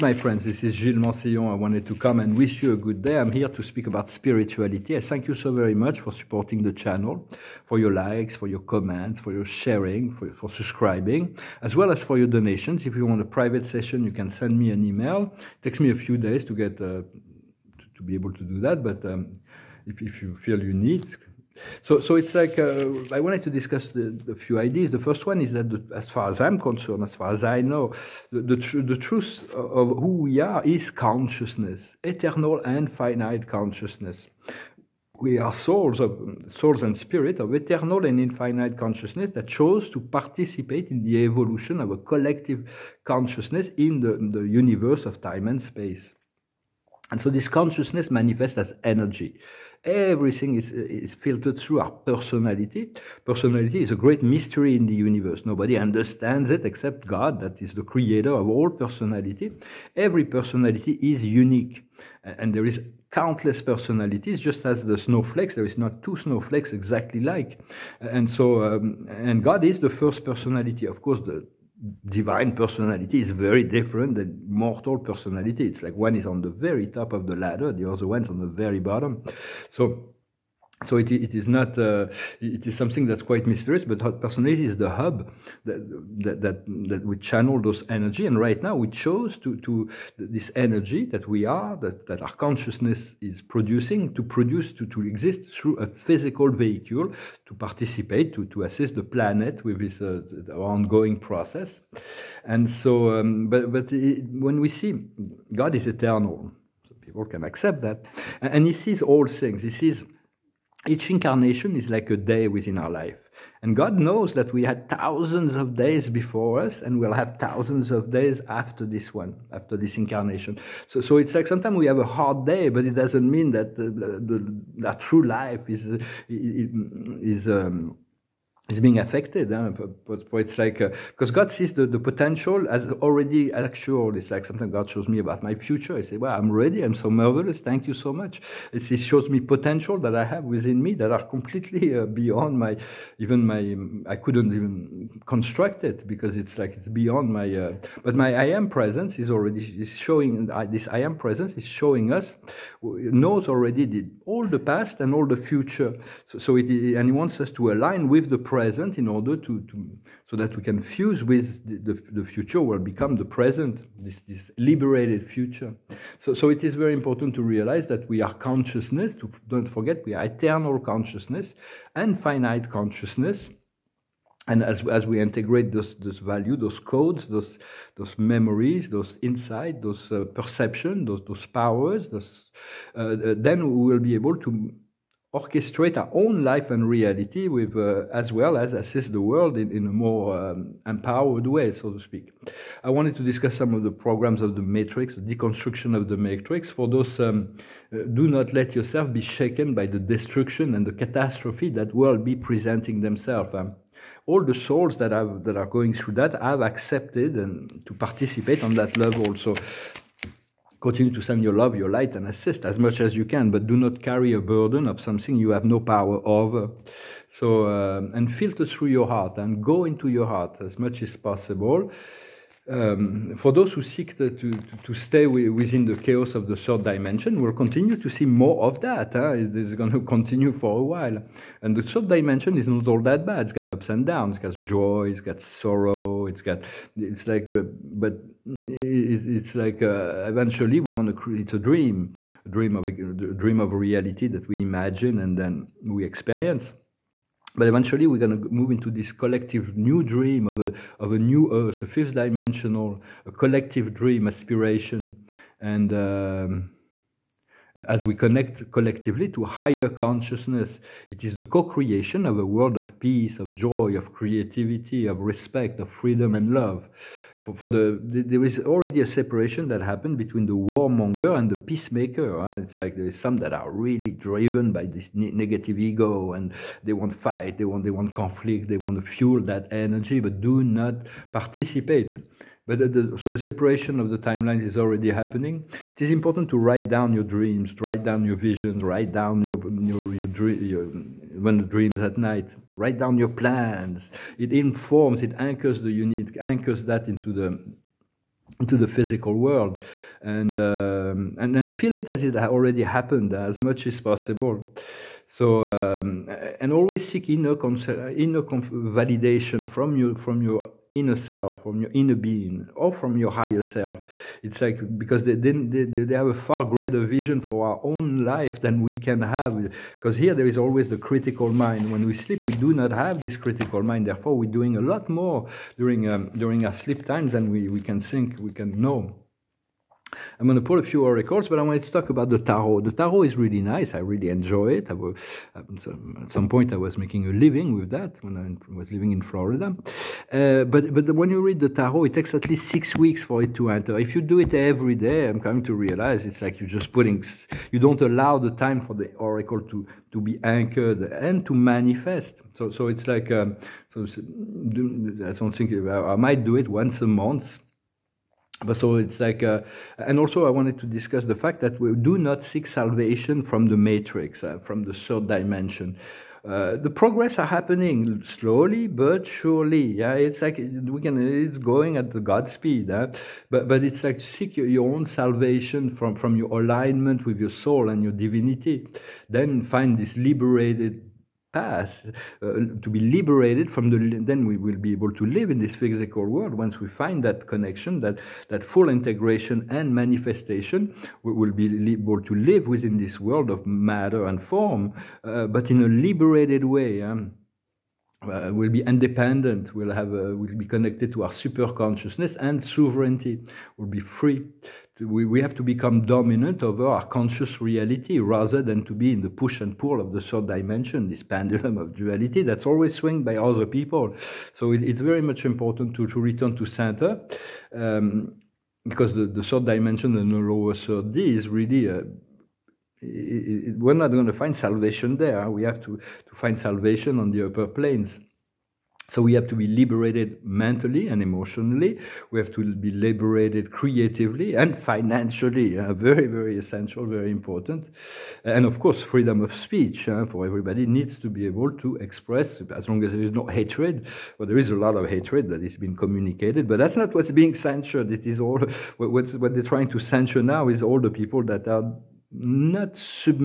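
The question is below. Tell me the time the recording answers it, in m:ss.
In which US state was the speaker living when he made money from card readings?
5:39.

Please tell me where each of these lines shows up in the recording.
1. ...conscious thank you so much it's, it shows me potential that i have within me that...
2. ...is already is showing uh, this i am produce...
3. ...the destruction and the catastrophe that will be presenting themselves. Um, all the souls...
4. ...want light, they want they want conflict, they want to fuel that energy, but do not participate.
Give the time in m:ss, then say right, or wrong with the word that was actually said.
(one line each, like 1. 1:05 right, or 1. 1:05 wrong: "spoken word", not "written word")
1. 2:17 wrong: "marvelous", not "conscious"
2. 2:29 wrong: "presence", not "produce"
3. 3:19 right
4. 4:36 wrong: "fight", not "light".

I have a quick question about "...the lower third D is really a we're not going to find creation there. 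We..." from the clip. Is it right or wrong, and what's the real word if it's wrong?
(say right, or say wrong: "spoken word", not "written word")
wrong: "salvation", not "creation".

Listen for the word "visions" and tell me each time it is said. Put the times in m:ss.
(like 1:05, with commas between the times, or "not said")
4:48, 5:17.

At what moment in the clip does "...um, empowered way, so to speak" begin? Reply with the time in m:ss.
3:10.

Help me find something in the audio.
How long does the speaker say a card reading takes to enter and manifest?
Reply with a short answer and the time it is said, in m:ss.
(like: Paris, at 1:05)
6 weeks, at 5:42.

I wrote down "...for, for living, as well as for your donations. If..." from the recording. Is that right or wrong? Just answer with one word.
wrong.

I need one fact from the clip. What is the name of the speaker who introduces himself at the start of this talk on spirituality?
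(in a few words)
Gilles Mansillon.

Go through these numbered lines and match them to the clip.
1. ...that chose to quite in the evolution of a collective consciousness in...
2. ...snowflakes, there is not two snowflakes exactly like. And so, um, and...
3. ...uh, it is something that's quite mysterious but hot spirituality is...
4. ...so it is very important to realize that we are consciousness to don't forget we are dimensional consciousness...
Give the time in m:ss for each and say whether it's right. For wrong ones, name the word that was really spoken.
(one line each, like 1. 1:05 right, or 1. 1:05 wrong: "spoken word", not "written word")
1. 0:39 wrong: "participate", not "quite"
2. 1:04 right
3. 1:21 wrong: "personality", not "spirituality"
4. 2:46 wrong: "eternal", not "dimensional".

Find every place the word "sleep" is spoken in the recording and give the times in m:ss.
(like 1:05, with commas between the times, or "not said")
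5:22, 5:26.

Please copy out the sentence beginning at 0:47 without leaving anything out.
And so this consciousness manifests as energy everything is, is filtered through our personality.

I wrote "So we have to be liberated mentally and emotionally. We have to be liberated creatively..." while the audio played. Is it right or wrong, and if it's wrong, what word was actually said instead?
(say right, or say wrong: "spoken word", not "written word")
right.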